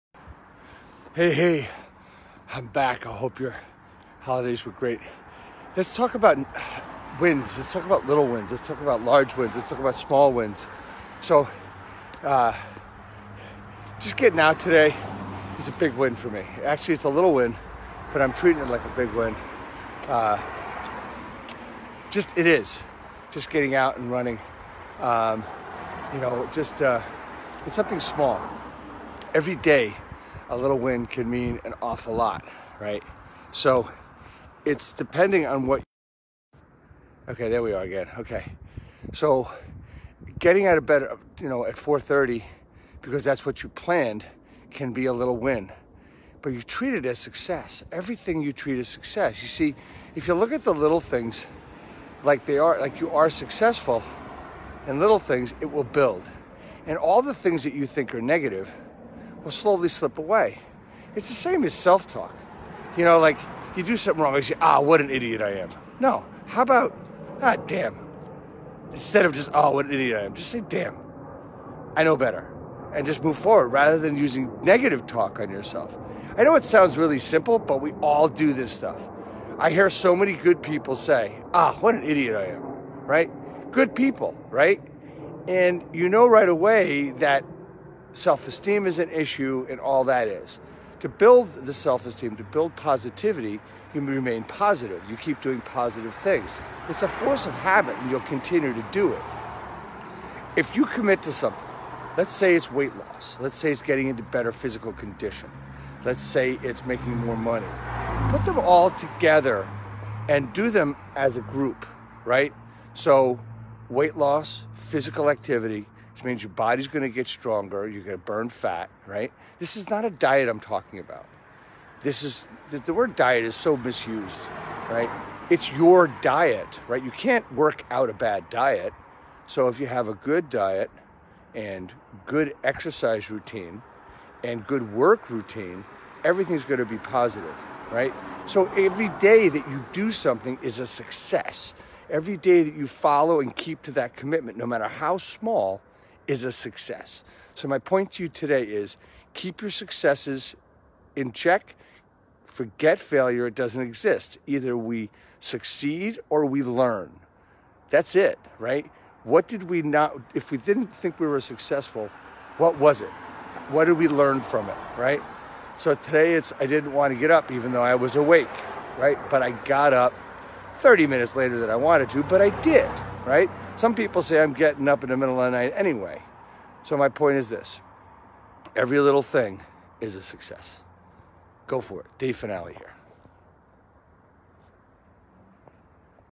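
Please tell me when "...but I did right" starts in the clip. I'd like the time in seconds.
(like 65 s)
172 s.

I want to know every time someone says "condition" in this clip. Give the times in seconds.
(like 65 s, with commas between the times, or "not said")
104 s.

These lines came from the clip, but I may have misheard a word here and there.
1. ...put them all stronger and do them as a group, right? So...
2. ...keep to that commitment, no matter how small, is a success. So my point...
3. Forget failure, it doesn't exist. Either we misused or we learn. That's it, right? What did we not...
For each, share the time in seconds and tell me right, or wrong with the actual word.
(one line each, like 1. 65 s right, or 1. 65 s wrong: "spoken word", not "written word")
1. 108 s wrong: "together", not "stronger"
2. 143 s right
3. 152 s wrong: "succeed", not "misused".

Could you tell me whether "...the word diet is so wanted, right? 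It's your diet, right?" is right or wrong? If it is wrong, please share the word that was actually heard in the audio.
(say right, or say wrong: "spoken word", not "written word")
wrong: "misused", not "wanted".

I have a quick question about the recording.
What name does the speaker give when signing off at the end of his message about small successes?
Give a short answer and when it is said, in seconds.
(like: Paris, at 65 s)
Dave Fanale, at 182 s.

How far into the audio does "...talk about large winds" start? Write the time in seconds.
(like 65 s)
8 s.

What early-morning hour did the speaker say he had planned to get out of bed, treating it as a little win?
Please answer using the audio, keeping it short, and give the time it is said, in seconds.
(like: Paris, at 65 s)
4:30, at 41 s.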